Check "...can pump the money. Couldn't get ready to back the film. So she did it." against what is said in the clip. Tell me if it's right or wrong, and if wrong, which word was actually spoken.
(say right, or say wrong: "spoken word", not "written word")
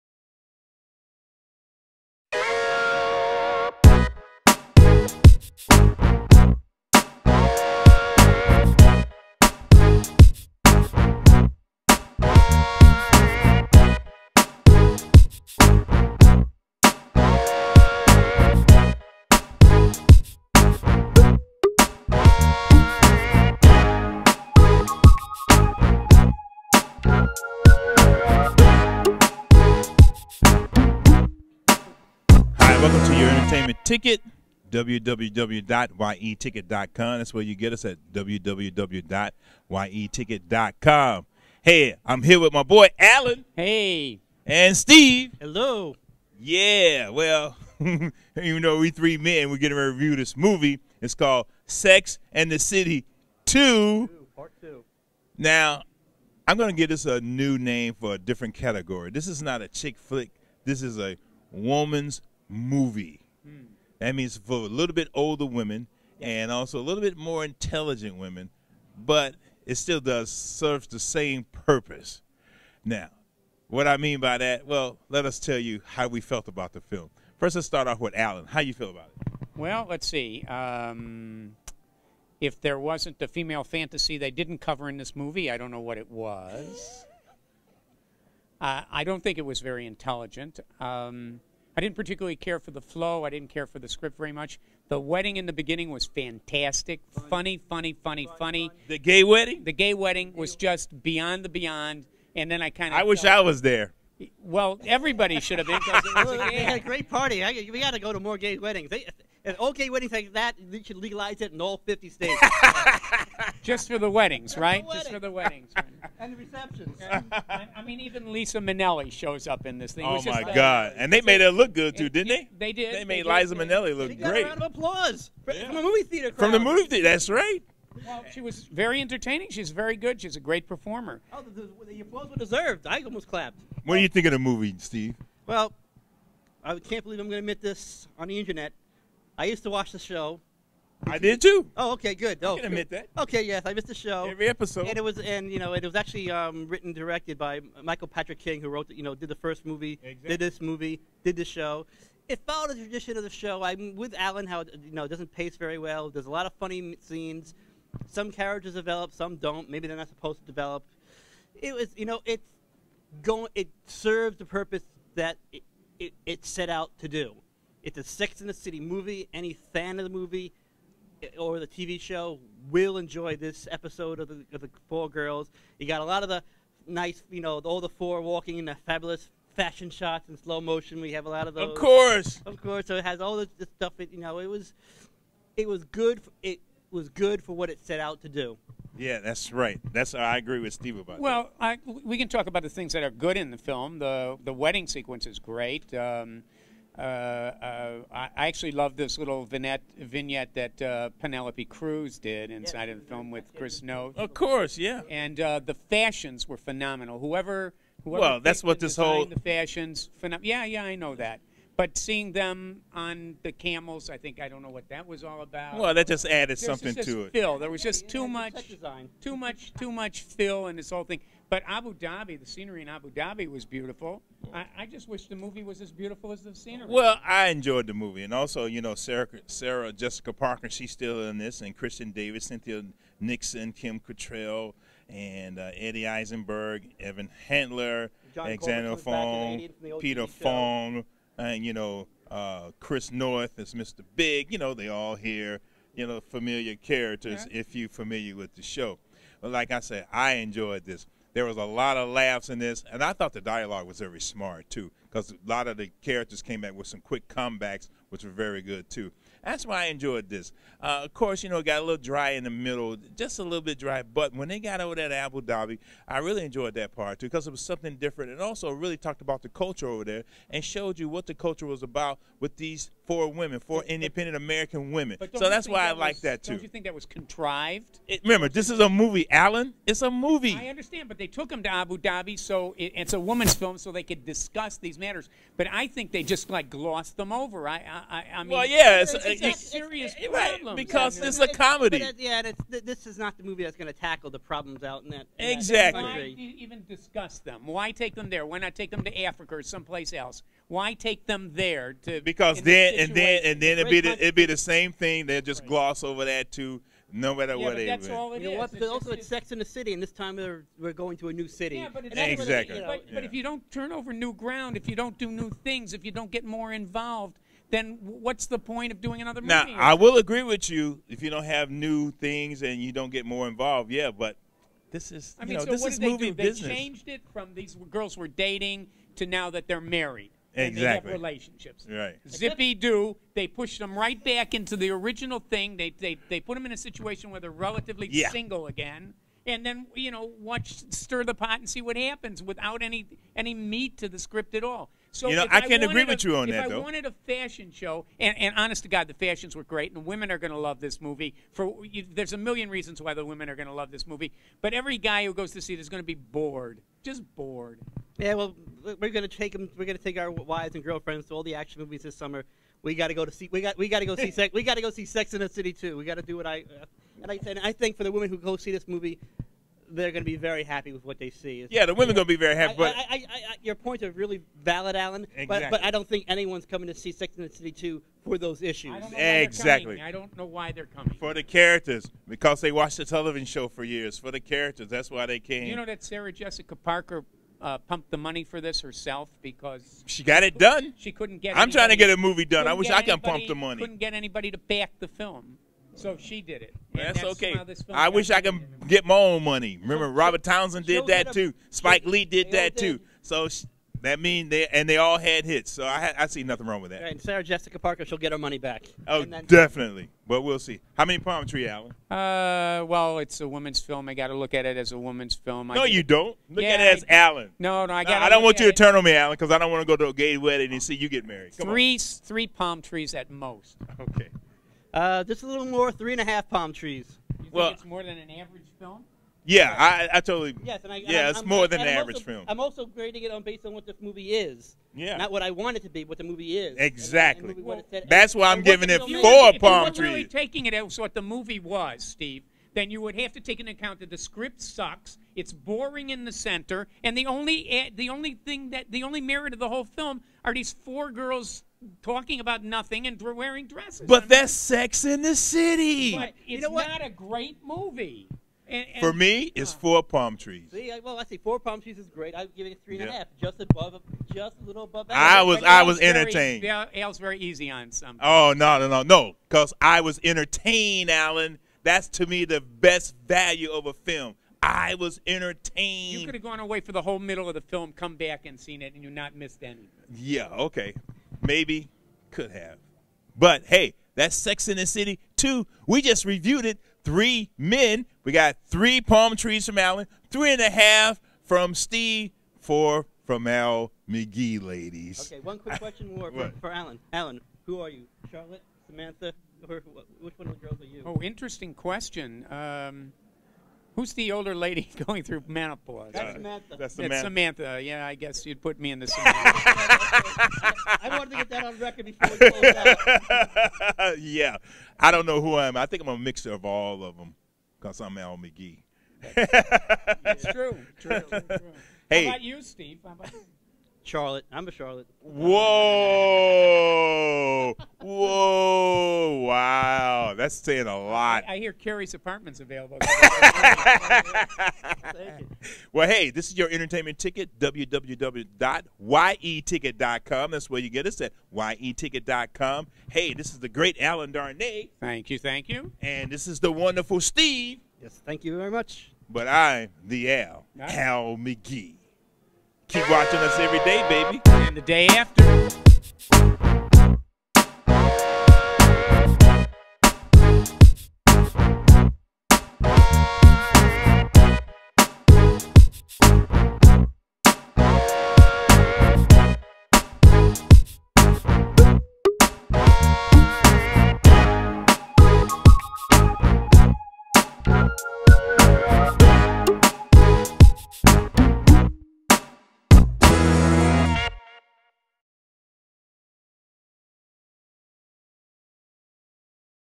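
wrong: "anybody", not "ready".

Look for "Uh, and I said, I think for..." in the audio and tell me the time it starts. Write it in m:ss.
6:06.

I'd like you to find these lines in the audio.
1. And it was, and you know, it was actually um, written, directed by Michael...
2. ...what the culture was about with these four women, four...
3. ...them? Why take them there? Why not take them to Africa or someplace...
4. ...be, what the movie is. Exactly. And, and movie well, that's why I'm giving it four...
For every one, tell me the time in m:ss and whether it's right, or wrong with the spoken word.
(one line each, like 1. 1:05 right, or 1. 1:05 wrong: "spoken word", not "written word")
1. 2:24 right
2. 4:31 right
3. 4:57 right
4. 7:15 right.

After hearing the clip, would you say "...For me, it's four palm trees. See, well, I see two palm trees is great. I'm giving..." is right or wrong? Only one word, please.
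wrong.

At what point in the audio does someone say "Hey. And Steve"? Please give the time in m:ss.
0:43.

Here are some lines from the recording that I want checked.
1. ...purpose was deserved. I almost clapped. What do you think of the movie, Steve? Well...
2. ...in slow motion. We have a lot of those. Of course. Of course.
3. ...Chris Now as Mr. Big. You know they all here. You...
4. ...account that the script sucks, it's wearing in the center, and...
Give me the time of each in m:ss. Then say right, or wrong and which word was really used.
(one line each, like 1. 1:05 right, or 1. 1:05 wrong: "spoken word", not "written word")
1. 2:12 wrong: "applause", not "purpose"
2. 3:00 right
3. 4:02 wrong: "Noth", not "Now"
4. 7:23 wrong: "boring", not "wearing".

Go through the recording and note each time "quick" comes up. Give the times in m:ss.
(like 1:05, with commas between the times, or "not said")
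4:17, 8:15.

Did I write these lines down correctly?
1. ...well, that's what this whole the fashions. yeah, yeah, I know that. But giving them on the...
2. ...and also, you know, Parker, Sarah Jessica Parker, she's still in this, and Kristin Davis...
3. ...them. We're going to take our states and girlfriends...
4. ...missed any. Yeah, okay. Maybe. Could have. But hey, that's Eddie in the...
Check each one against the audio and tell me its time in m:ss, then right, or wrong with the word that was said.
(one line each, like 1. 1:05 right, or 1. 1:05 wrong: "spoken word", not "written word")
1. 3:28 wrong: "seeing", not "giving"
2. 3:48 wrong: "Sarah", not "Parker"
3. 5:59 wrong: "wives", not "states"
4. 7:59 wrong: "Sex", not "Eddie".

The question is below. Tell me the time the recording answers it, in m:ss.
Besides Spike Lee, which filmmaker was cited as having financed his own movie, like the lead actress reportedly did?
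6:40.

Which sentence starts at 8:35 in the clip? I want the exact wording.
I think I'm a mixture of all of them because I'm Al McGhee.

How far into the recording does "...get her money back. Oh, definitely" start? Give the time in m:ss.
6:48.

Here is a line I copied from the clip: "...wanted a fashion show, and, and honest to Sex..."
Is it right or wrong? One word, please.
wrong.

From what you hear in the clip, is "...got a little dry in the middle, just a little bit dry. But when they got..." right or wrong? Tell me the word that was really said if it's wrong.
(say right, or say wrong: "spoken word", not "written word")
right.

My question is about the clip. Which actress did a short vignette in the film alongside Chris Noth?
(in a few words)
Penelope Cruz.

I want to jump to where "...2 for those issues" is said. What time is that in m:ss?
6:17.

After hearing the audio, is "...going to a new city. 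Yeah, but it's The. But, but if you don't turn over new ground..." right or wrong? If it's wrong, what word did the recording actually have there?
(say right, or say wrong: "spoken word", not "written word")
wrong: "Exactly", not "The".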